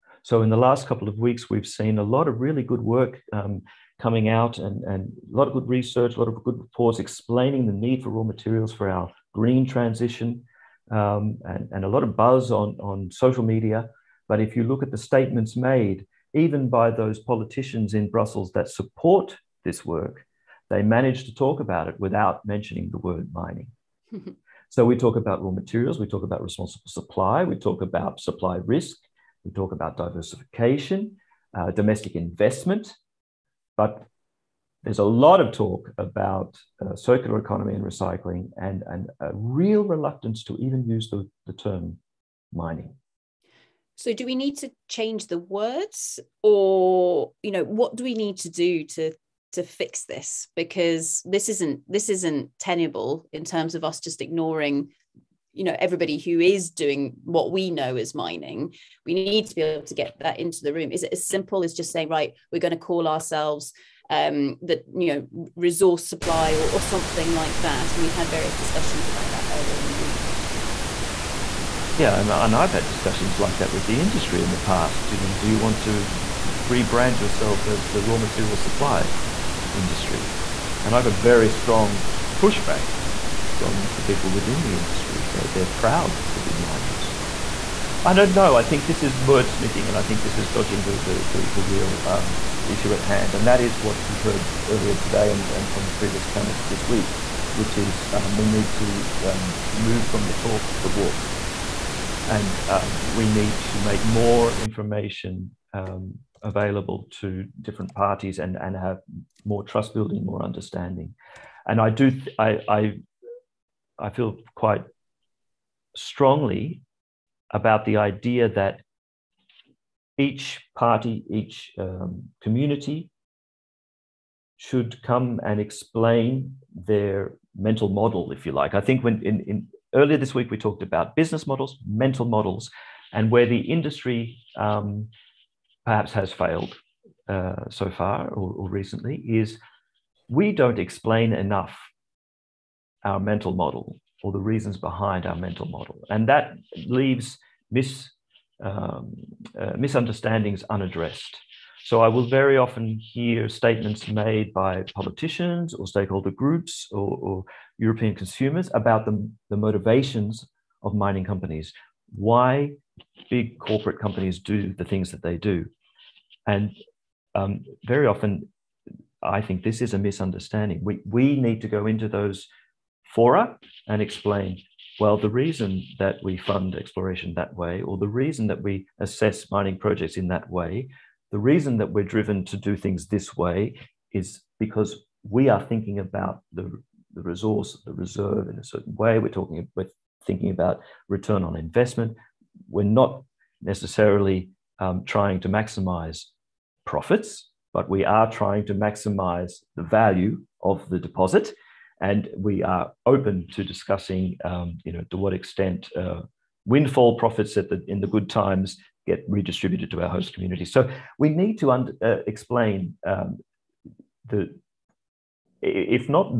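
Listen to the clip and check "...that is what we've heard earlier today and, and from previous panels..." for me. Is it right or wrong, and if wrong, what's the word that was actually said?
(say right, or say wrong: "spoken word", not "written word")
right.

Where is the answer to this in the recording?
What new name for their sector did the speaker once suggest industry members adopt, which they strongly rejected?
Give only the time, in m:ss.
1:18.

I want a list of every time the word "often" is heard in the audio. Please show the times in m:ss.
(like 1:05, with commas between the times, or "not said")
2:32, 2:48.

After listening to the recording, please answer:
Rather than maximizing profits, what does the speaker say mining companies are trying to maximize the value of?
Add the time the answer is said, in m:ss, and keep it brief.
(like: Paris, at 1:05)
the deposit, at 3:20.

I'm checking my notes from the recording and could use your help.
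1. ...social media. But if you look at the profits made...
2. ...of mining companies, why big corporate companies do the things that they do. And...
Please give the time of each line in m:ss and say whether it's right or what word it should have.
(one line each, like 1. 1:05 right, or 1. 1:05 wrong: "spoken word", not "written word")
1. 0:13 wrong: "statements", not "profits"
2. 2:40 right.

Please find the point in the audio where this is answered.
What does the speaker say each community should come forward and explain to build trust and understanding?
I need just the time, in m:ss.
2:06.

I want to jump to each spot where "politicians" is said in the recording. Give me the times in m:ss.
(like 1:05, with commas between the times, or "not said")
0:17, 2:34.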